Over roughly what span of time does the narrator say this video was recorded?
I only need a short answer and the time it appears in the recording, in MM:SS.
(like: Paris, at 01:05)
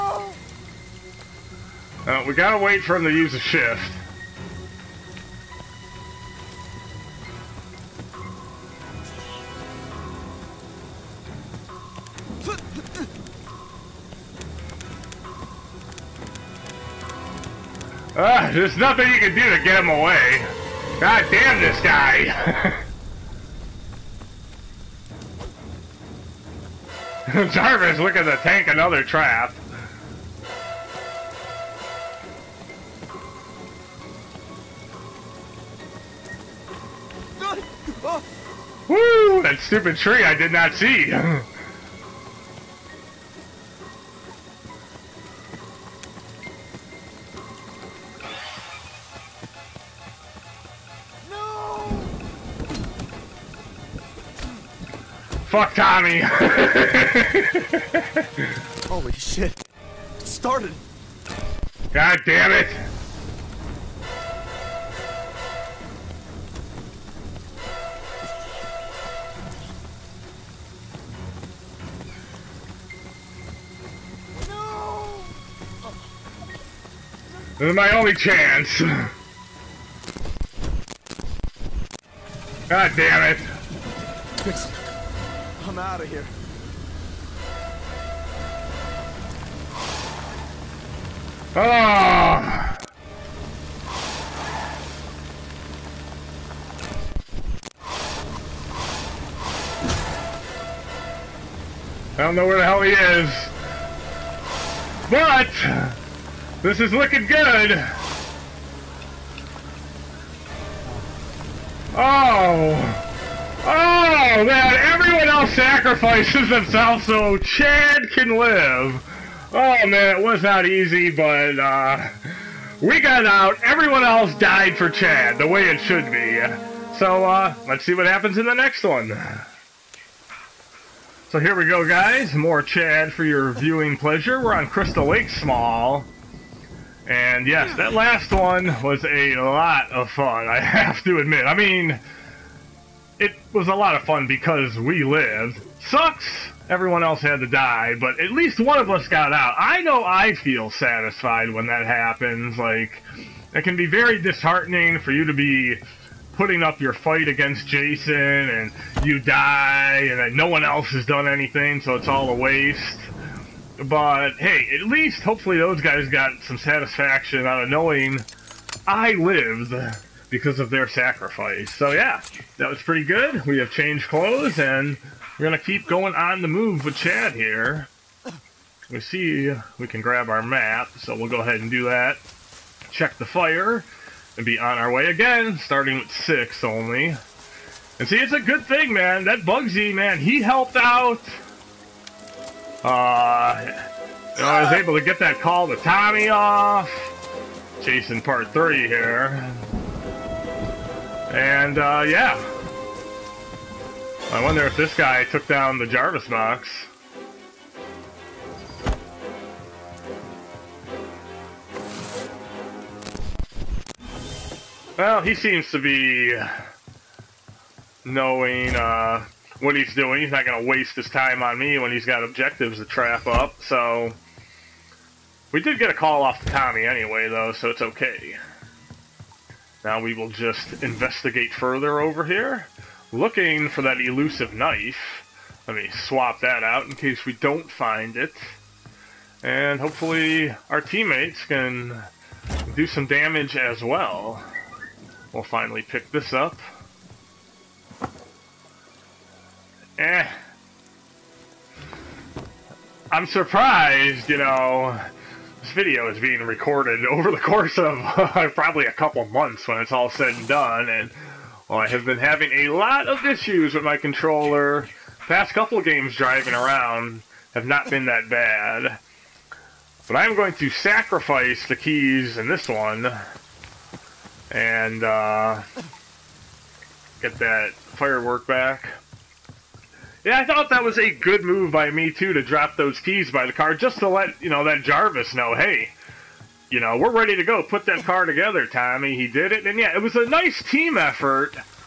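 a couple months, at 04:18.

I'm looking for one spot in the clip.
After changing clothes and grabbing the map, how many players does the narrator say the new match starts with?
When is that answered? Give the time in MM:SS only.
03:06.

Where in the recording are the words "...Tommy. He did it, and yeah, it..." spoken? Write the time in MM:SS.
04:48.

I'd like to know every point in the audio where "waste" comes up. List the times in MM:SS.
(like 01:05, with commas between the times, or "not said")
02:42, 03:40.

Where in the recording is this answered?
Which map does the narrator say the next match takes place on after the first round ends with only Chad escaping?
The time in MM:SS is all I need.
02:14.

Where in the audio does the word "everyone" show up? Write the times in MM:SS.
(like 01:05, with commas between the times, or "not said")
01:54, 02:03, 02:26.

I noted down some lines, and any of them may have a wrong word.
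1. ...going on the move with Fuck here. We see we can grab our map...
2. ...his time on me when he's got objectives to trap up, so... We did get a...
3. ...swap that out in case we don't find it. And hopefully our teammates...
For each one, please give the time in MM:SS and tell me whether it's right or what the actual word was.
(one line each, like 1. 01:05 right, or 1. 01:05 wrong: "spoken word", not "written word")
1. 02:55 wrong: "Chad", not "Fuck"
2. 03:40 right
3. 03:55 right.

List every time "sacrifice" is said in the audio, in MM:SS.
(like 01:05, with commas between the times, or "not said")
01:55, 02:50, 04:30.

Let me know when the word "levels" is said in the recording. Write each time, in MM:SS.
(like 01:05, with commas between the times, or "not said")
not said.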